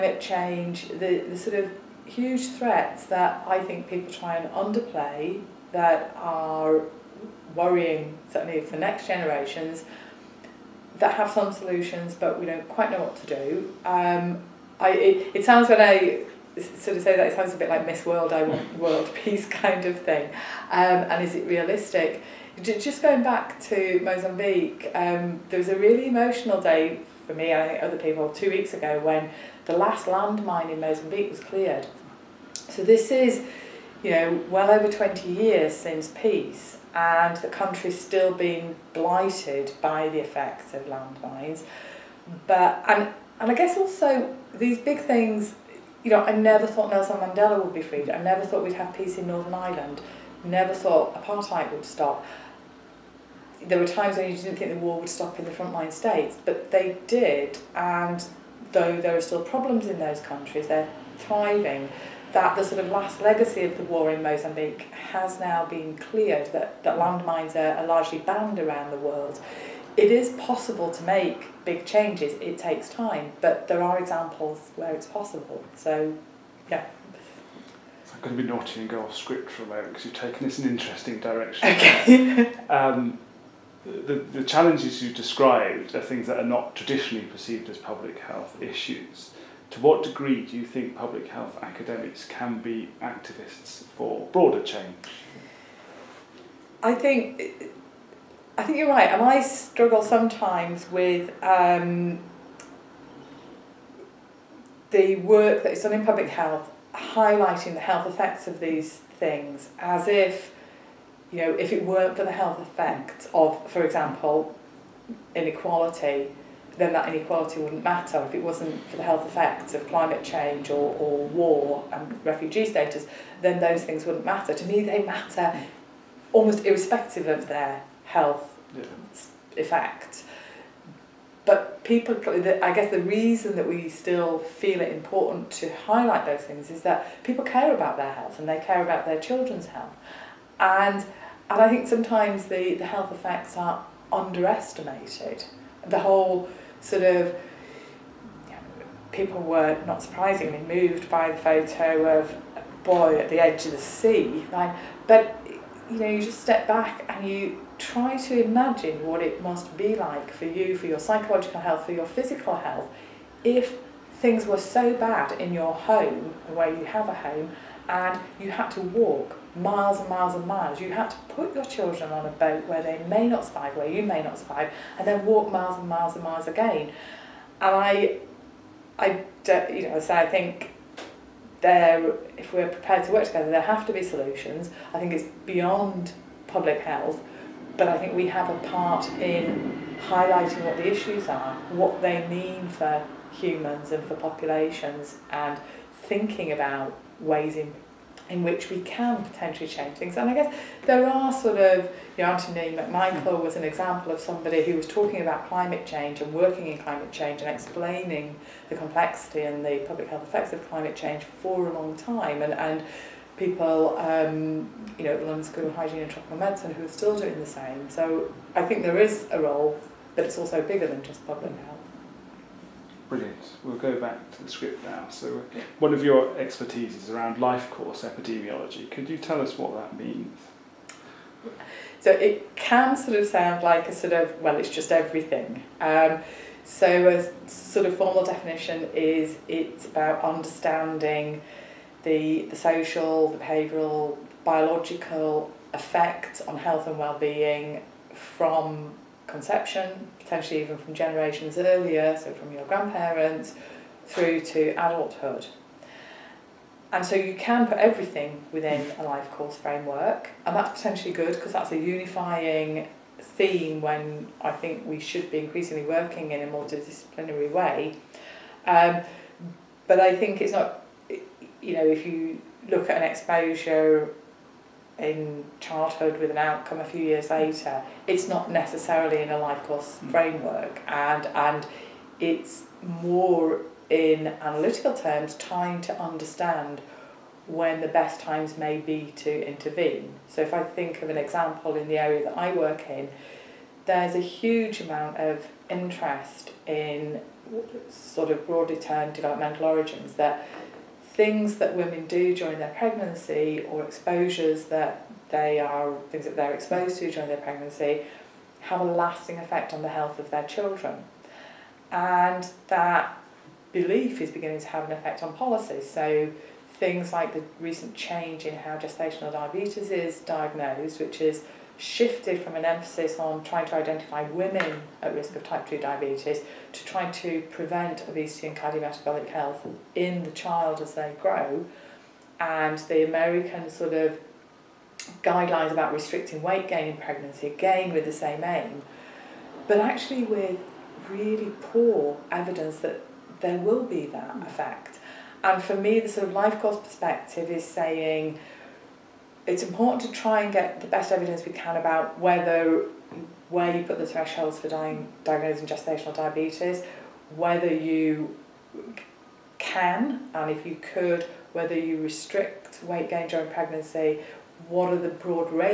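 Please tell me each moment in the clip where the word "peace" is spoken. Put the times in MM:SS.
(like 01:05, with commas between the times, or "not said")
00:19, 00:36, 00:48.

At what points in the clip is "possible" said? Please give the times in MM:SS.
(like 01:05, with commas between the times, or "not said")
01:10, 01:15.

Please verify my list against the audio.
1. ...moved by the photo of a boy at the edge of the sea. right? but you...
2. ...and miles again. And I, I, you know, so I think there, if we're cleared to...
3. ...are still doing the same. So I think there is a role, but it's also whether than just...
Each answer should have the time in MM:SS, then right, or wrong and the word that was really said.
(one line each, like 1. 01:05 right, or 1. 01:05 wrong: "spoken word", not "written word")
1. 02:30 right
2. 02:56 wrong: "prepared", not "cleared"
3. 03:36 wrong: "bigger", not "whether".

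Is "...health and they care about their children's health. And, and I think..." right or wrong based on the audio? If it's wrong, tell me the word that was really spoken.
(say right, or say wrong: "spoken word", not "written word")
right.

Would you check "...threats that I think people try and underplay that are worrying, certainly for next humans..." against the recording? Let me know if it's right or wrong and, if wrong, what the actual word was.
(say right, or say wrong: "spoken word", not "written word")
wrong: "generations", not "humans".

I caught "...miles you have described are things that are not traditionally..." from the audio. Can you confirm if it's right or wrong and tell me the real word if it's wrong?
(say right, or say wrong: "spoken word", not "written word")
wrong: "challenges", not "miles".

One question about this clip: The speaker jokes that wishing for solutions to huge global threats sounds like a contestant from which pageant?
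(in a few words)
Miss World.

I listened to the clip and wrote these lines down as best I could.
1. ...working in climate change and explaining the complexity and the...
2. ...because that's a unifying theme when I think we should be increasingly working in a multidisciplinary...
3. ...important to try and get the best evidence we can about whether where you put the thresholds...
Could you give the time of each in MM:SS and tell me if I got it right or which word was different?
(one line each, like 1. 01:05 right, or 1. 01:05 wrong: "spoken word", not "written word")
1. 03:26 right
2. 04:21 right
3. 05:49 right.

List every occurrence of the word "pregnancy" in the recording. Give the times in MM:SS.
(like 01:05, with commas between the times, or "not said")
05:02, 05:07, 05:36, 06:03.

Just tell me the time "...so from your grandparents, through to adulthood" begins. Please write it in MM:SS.
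04:12.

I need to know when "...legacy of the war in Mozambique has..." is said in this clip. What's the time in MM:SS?
01:03.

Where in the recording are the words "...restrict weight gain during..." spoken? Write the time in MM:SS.
06:02.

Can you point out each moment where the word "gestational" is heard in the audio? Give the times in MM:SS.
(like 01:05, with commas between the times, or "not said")
05:18, 05:55.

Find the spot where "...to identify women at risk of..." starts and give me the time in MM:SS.
05:23.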